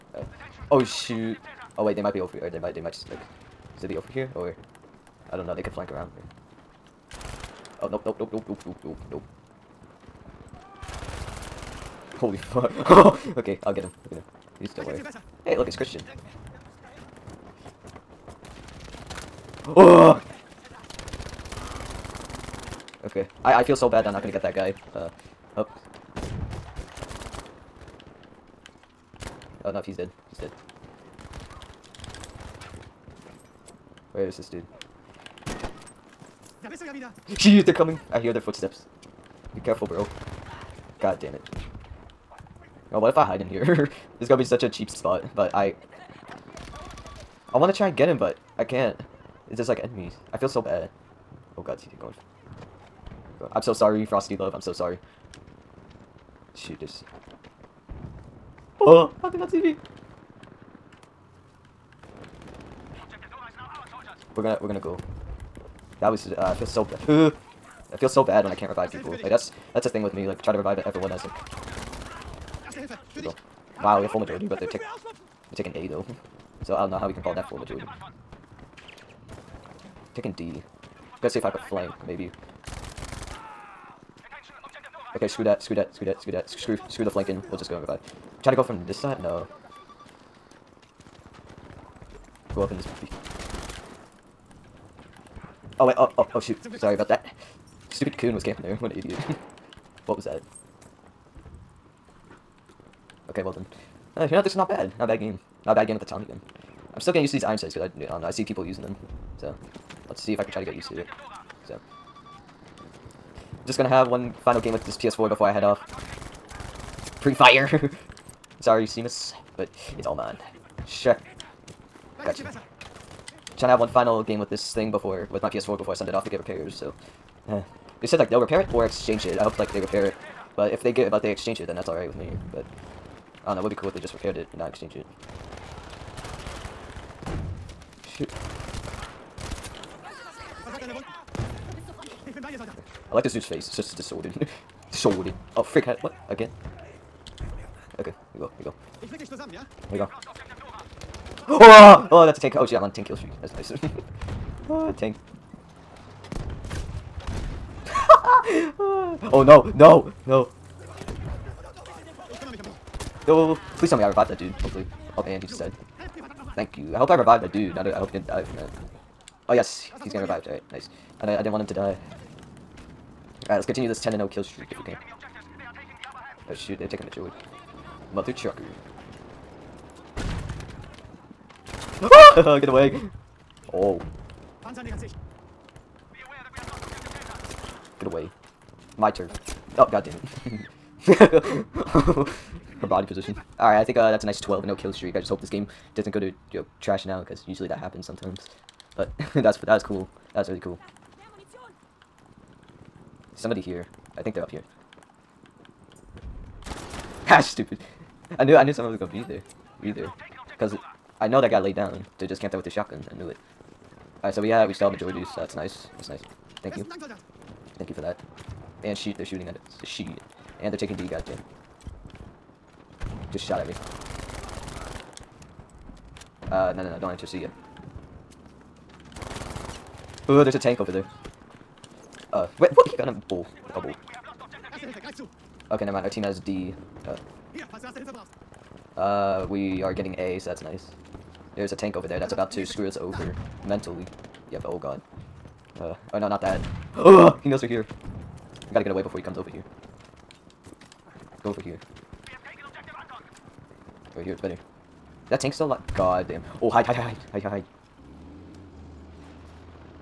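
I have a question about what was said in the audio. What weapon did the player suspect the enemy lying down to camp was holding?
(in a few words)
Shotgun.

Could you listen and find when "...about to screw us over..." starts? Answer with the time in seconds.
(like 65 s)
242 s.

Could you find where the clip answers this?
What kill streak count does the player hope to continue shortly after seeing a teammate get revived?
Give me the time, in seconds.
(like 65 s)
173 s.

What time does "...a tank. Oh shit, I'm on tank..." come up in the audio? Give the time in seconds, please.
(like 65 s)
152 s.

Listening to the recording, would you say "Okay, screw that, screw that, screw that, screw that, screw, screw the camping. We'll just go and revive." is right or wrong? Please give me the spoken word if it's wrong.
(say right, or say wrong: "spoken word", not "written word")
wrong: "flanking", not "camping".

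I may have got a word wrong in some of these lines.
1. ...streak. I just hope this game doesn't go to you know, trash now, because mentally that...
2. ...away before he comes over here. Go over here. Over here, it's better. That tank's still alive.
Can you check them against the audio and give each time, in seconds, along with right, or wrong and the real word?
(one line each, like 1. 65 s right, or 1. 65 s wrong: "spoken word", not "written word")
1. 194 s wrong: "usually", not "mentally"
2. 248 s right.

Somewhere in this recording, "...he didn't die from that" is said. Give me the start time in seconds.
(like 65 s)
168 s.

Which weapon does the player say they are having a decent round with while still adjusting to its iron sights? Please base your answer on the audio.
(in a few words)
Tommy gun.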